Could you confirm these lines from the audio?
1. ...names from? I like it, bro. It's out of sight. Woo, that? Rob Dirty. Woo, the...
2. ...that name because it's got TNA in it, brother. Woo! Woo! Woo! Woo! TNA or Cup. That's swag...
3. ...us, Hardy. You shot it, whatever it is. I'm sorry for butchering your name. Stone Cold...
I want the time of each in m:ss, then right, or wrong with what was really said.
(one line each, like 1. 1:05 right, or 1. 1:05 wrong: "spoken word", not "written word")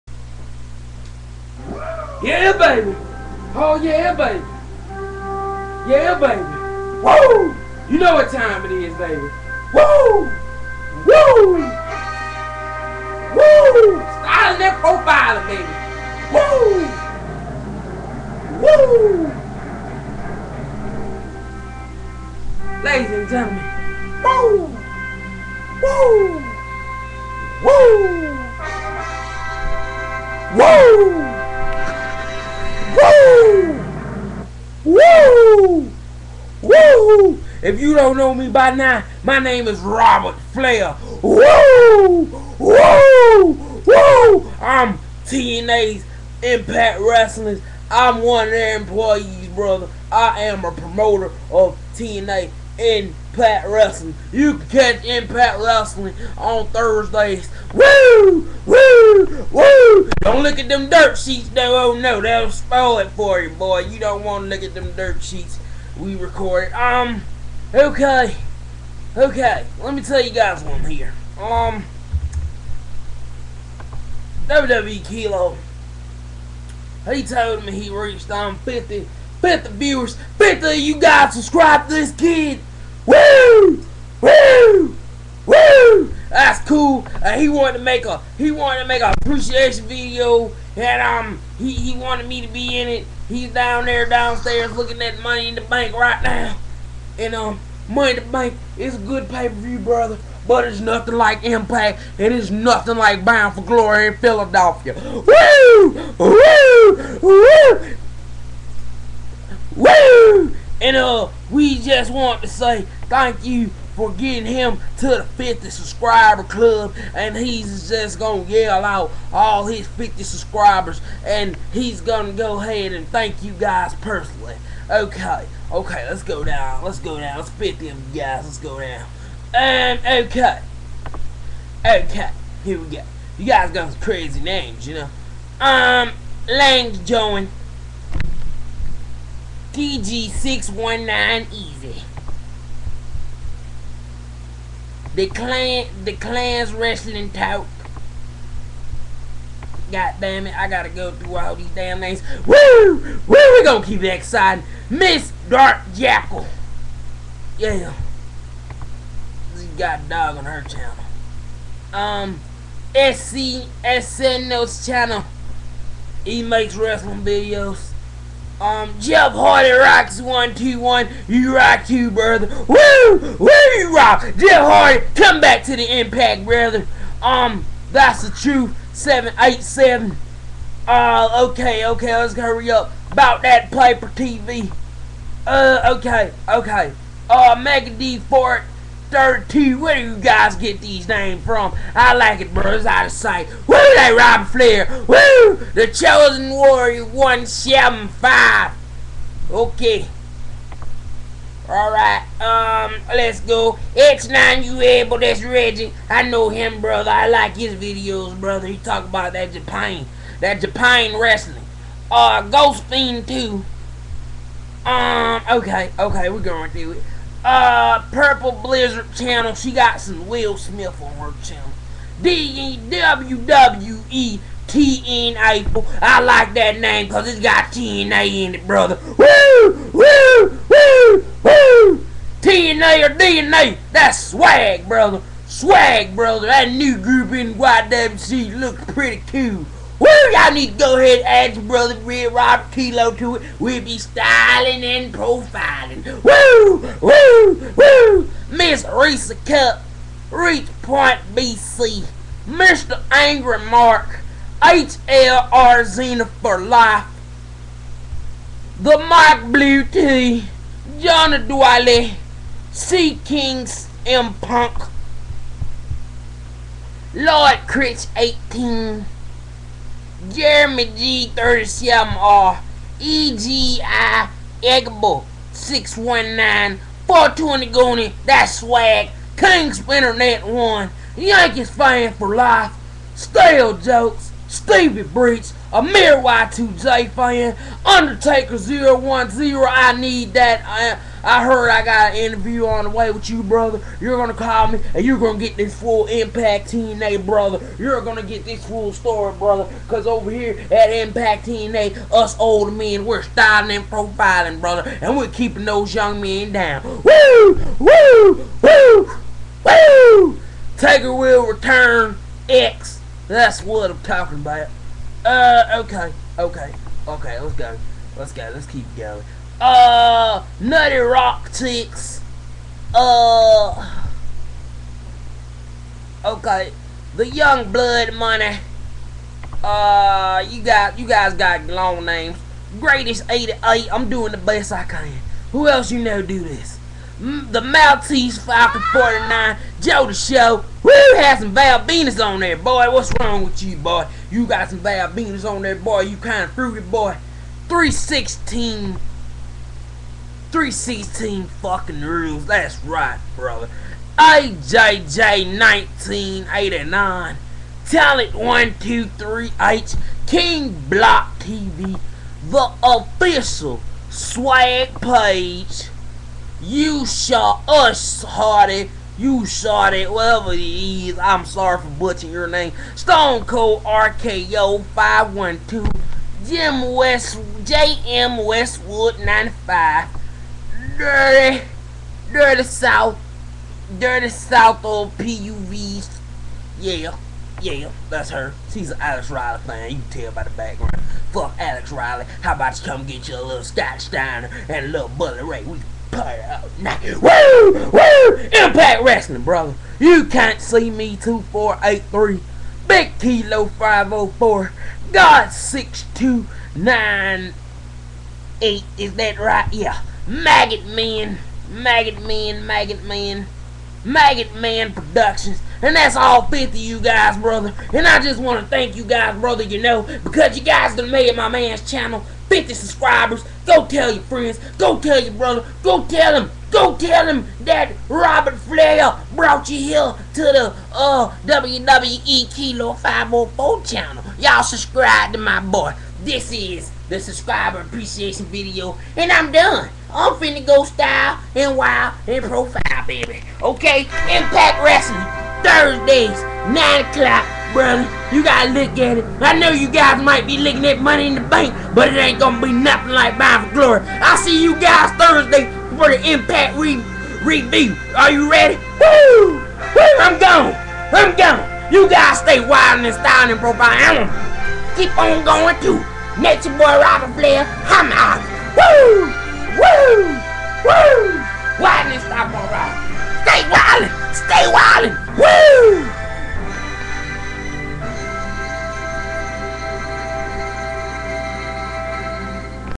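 1. 3:11 wrong: "Flair", not "Dirty"
2. 3:46 wrong: "DNA", not "Cup"
3. 6:07 right.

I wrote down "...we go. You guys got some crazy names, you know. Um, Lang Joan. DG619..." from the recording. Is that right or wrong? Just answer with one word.
right.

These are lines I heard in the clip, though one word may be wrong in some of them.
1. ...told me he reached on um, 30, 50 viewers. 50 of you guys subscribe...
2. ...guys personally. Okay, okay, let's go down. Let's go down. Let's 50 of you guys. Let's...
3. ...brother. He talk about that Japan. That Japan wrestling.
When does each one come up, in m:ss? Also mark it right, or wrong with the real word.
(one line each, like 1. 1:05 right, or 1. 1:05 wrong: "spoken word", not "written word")
1. 1:17 wrong: "50", not "30"
2. 2:03 right
3. 3:28 right.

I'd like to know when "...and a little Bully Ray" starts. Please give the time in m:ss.
6:34.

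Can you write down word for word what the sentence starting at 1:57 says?
And he's just going to yell out all his 50 subscribers.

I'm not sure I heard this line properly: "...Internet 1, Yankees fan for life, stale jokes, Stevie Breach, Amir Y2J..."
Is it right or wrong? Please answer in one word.
right.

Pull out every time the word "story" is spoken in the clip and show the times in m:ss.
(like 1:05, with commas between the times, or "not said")
4:58.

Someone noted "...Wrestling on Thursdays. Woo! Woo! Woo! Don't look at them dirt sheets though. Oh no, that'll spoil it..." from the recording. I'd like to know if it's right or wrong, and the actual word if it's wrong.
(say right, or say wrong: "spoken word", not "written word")
right.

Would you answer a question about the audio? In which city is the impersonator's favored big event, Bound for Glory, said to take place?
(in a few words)
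Philadelphia.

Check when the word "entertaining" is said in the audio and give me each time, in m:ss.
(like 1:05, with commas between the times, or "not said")
not said.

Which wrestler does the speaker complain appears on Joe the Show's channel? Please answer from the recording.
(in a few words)
Val Venis.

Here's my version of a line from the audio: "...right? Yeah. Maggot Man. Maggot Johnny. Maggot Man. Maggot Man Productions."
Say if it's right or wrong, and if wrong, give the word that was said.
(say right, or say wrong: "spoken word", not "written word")
wrong: "Man", not "Johnny".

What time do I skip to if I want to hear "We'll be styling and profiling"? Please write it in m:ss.
4:03.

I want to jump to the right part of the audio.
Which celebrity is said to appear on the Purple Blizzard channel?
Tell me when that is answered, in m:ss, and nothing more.
3:39.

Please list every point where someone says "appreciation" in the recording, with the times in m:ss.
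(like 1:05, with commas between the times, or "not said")
1:29, 7:17.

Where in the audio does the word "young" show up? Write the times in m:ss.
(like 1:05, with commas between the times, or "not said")
5:05, 5:27.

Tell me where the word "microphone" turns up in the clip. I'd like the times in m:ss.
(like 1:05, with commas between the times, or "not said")
not said.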